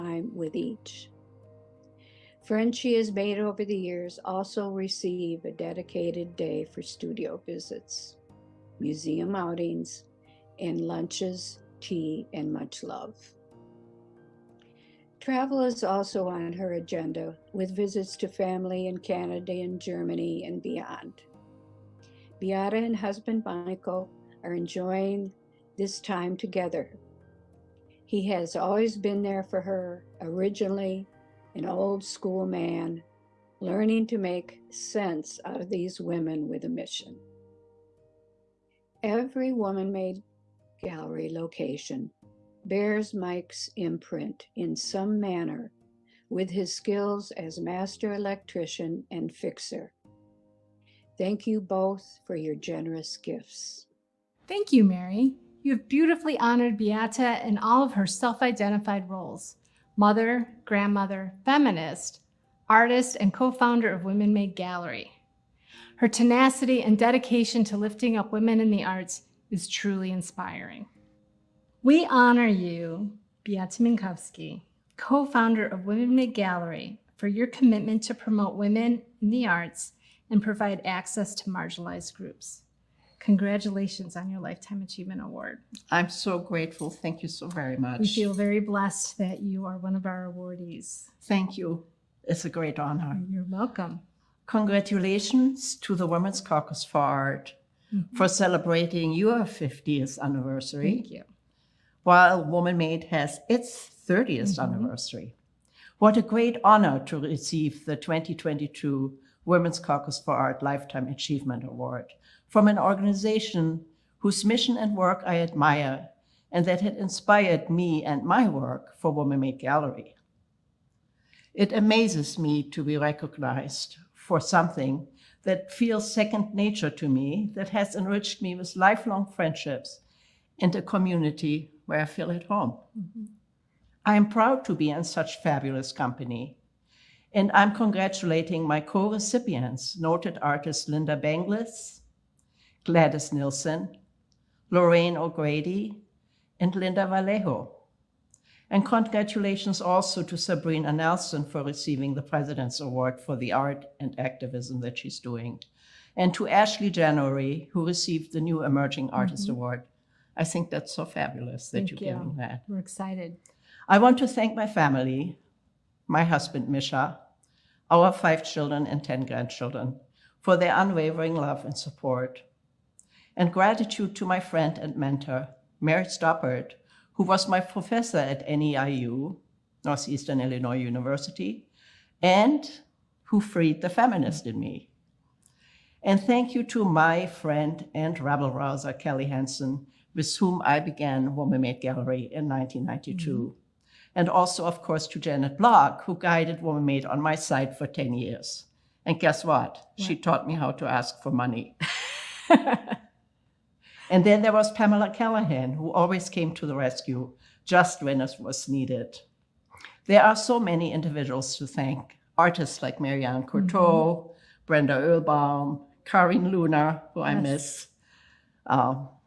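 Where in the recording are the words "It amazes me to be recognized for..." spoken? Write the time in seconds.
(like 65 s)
121 s.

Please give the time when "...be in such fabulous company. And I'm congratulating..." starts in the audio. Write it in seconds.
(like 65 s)
134 s.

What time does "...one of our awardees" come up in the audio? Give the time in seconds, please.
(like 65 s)
89 s.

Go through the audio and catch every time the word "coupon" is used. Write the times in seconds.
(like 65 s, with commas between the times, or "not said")
not said.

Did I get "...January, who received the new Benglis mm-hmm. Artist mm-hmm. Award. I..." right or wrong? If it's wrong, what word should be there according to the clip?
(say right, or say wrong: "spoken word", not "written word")
wrong: "Emerging", not "Benglis".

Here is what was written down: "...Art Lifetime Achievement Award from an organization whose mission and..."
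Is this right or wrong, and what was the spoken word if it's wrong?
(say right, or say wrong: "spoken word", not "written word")
right.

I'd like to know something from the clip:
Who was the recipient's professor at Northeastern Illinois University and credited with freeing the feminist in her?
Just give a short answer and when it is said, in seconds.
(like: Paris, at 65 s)
Mary Stoppert, at 175 s.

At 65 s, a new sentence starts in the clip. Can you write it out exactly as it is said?
Her tenacity and dedication to lifting up women in the arts is truly inspiring.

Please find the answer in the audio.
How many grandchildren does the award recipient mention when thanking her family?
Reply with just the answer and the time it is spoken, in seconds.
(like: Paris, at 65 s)
10, at 169 s.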